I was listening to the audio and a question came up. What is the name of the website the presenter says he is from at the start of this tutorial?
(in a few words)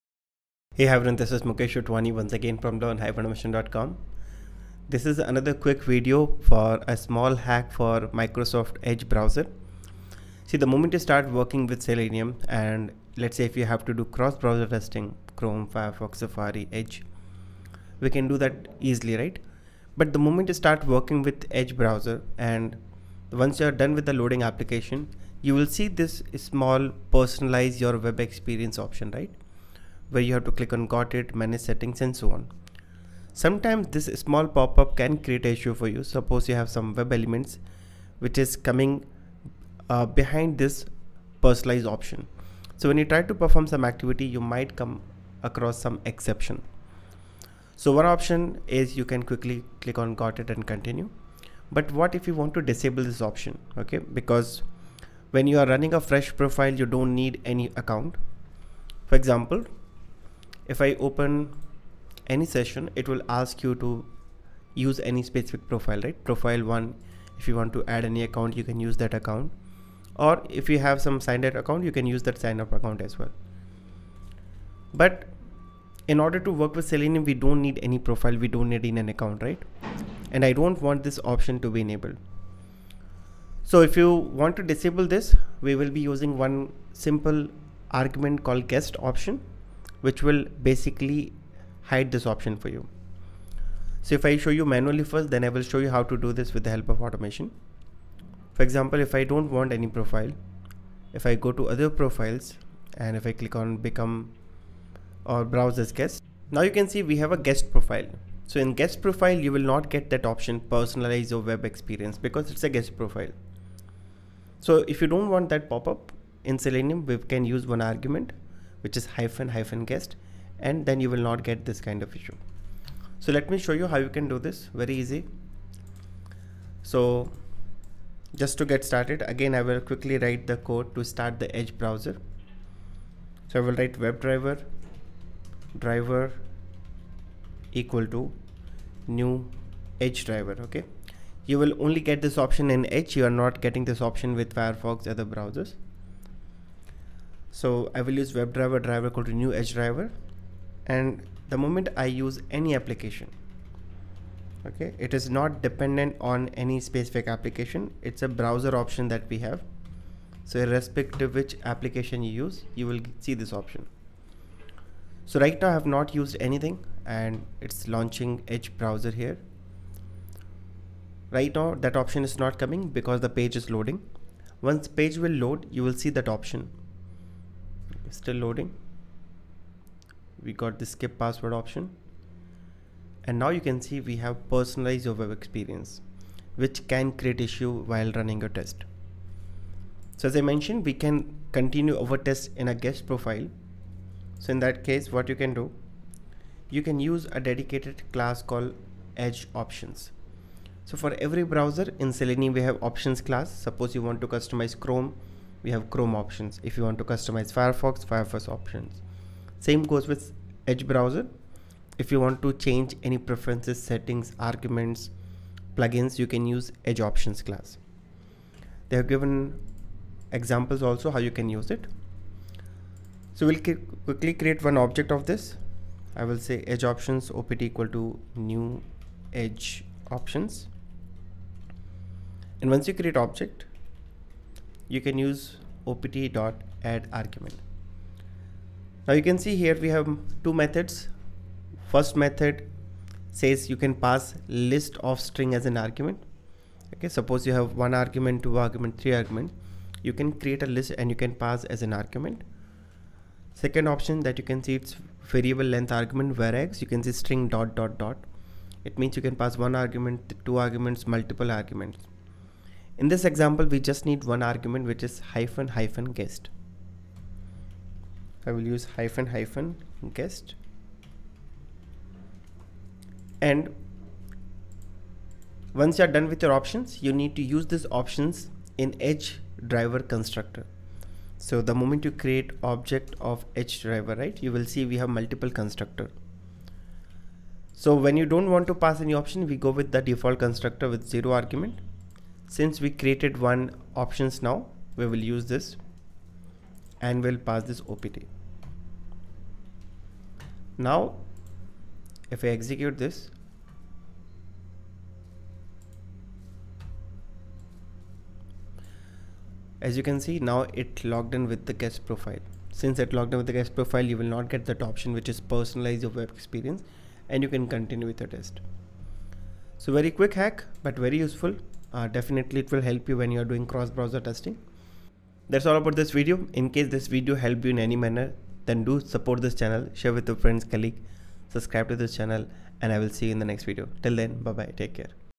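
learn-automation.com.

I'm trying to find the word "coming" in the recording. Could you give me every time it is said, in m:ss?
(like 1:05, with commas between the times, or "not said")
0:38, 2:52.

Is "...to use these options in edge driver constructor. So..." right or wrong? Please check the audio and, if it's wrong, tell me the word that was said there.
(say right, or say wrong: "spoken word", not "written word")
right.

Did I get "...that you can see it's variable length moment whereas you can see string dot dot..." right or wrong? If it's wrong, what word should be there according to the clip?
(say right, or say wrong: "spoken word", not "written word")
wrong: "argument", not "moment".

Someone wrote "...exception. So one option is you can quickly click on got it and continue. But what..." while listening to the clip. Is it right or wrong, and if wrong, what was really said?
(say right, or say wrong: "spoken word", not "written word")
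right.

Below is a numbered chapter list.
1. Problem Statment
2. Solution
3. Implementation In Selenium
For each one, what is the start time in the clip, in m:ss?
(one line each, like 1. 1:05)
1. 0:10
2. 1:00
3. 2:12.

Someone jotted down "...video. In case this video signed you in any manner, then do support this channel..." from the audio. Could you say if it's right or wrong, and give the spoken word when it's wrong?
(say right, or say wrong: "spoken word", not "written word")
wrong: "helped", not "signed".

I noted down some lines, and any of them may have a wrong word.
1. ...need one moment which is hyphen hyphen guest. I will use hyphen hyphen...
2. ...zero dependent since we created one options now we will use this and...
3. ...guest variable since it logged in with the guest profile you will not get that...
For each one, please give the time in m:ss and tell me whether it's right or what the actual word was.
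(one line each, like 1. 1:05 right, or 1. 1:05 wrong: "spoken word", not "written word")
1. 4:24 wrong: "argument", not "moment"
2. 4:51 wrong: "argument", not "dependent"
3. 5:11 wrong: "profile", not "variable".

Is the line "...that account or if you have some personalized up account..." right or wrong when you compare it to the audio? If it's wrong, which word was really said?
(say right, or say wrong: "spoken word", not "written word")
wrong: "signed", not "personalized".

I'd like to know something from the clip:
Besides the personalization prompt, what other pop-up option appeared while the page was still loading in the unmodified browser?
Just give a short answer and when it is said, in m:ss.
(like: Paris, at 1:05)
skip password, at 3:00.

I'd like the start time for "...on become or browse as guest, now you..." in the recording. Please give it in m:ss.
1:43.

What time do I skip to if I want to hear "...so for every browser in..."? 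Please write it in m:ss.
3:20.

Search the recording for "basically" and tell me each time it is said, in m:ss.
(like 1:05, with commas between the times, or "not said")
1:30.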